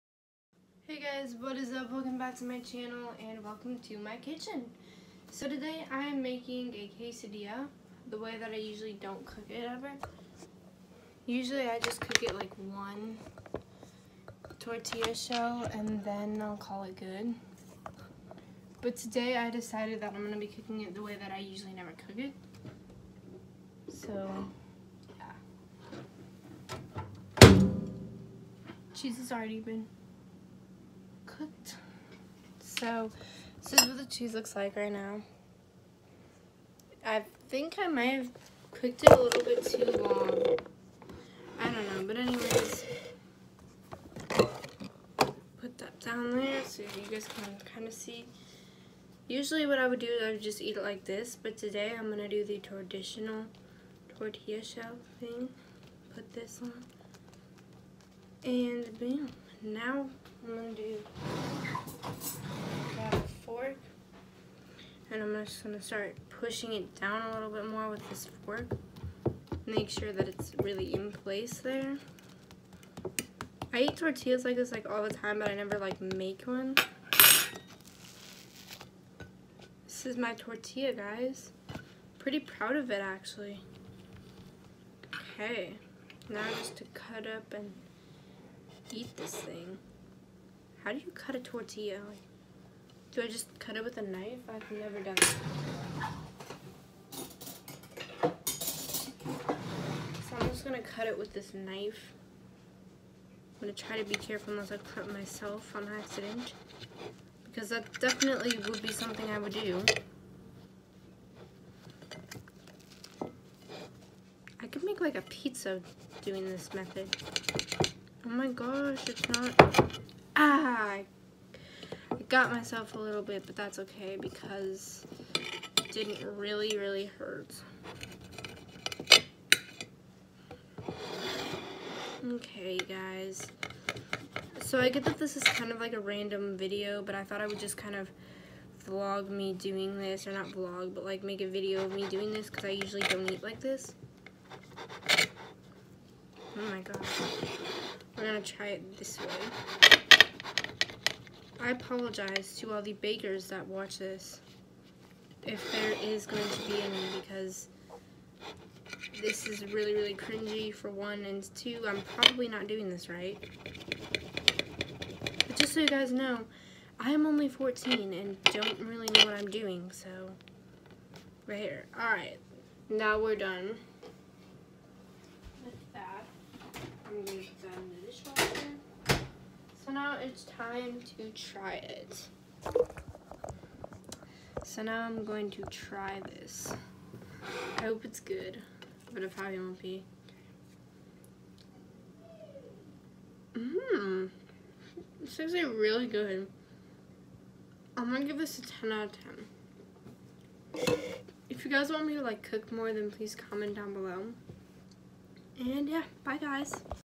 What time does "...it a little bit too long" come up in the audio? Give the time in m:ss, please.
0:39.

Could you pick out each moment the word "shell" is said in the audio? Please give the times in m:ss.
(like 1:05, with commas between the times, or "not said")
0:15, 0:54.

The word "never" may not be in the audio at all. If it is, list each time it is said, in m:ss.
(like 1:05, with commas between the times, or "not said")
0:21, 1:15, 1:34.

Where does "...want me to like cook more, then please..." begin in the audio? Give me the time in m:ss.
3:21.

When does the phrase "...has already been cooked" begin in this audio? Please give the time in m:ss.
0:29.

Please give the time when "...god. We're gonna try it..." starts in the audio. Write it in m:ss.
2:26.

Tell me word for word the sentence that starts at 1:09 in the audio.
Make sure that it's really in place there.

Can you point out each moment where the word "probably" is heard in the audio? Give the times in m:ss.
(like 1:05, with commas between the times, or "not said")
2:42, 3:09.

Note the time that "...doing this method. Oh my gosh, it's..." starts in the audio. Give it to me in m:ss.
1:56.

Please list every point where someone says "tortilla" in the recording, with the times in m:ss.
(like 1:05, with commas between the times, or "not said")
0:14, 0:54, 1:13, 1:20, 1:31.